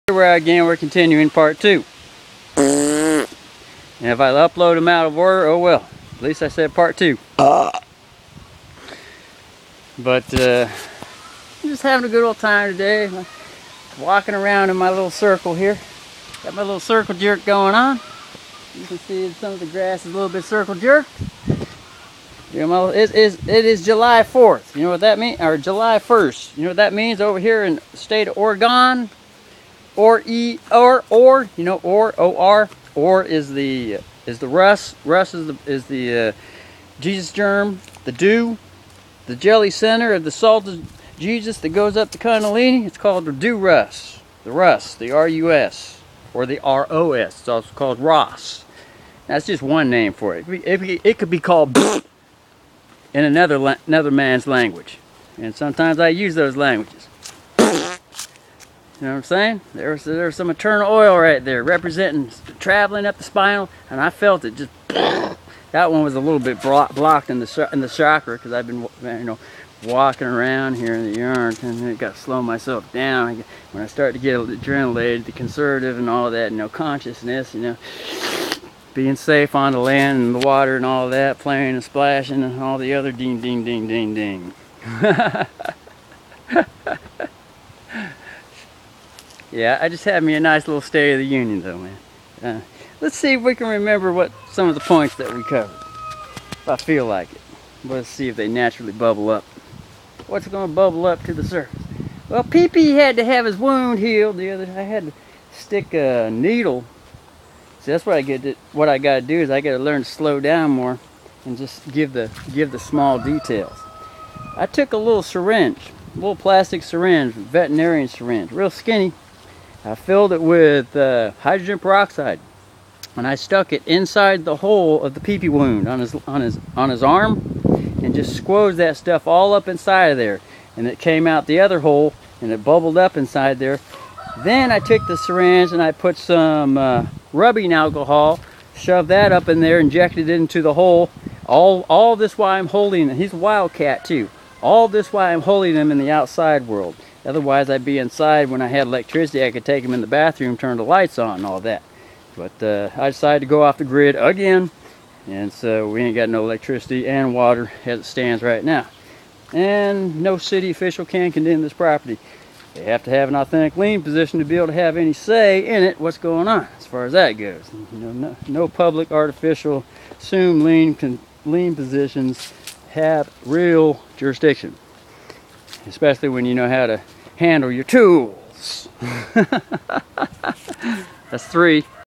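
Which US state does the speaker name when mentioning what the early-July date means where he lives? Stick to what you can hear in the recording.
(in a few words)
Oregon.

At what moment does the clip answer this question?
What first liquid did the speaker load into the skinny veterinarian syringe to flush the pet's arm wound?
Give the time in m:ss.
2:01.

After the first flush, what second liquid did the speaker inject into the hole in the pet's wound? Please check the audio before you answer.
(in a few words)
rubbing alcohol.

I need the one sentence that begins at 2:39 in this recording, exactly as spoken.
And no city official can condemn this property.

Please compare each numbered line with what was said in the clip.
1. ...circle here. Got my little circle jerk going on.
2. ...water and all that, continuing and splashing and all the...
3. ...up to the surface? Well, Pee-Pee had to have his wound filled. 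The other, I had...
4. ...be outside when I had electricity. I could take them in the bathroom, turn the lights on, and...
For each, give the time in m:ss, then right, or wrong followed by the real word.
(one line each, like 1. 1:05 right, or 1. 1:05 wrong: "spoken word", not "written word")
1. 0:15 right
2. 1:20 wrong: "playing", not "continuing"
3. 1:41 wrong: "healed", not "filled"
4. 2:27 wrong: "inside", not "outside".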